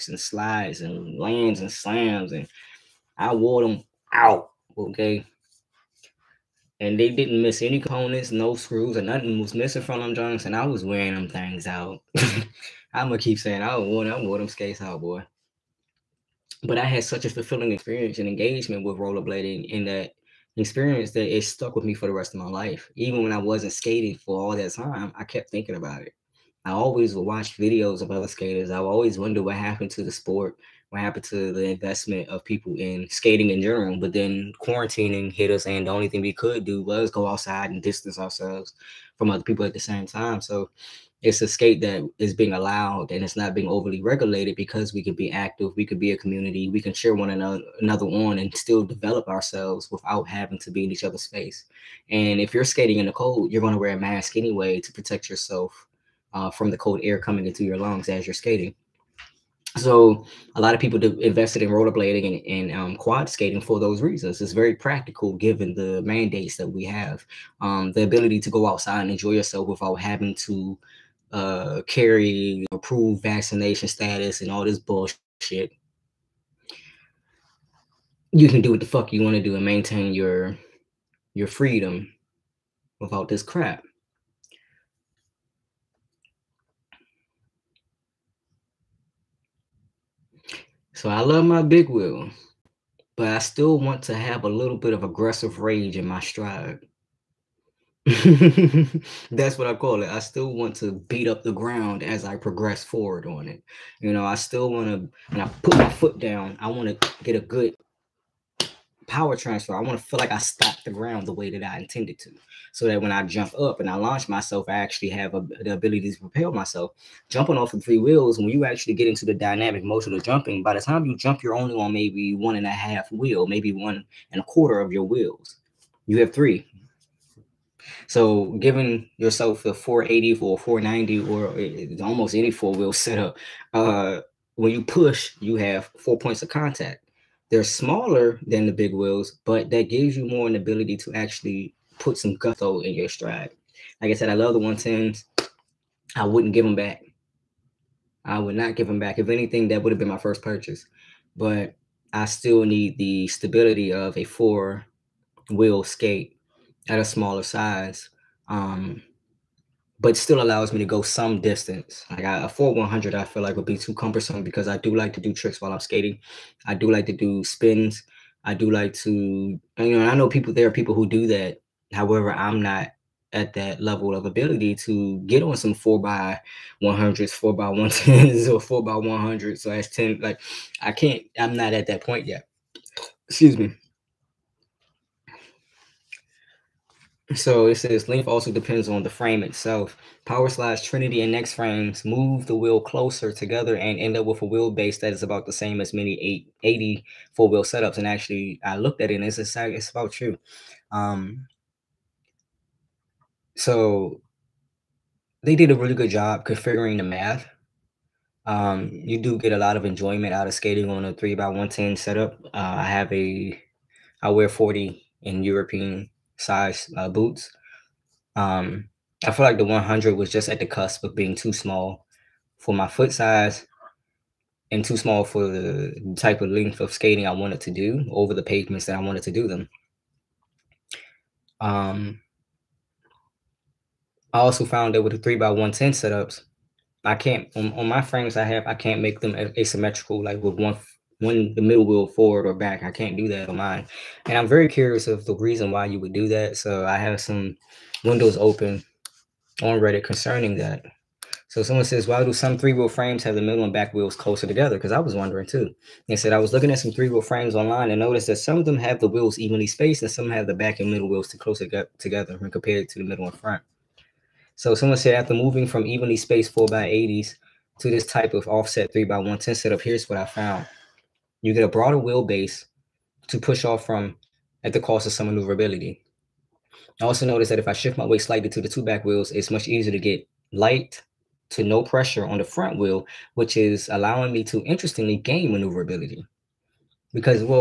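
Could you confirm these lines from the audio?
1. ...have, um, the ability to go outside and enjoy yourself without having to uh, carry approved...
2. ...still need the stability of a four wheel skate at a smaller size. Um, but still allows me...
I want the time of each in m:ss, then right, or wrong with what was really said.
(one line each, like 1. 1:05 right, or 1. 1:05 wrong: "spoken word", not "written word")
1. 1:06 right
2. 2:32 right.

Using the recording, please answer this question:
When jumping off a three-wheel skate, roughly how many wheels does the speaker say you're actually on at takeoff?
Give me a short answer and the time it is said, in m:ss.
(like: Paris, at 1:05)
1.5, at 2:02.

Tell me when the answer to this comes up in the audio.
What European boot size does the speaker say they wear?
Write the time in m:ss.
3:34.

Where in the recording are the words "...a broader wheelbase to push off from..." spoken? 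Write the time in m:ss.
4:31.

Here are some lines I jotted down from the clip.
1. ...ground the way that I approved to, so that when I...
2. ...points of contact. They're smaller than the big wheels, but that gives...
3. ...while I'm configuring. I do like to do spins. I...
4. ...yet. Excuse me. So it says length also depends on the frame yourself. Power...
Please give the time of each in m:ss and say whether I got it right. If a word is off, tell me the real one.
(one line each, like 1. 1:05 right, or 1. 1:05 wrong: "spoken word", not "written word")
1. 1:50 wrong: "intended", not "approved"
2. 2:16 right
3. 2:45 wrong: "skating", not "configuring"
4. 3:02 wrong: "itself", not "yourself".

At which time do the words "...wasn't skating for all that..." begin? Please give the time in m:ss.
0:23.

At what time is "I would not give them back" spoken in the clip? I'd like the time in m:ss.
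2:28.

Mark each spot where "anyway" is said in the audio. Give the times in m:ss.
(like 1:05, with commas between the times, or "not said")
0:54.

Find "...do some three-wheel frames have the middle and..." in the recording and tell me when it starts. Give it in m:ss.
4:12.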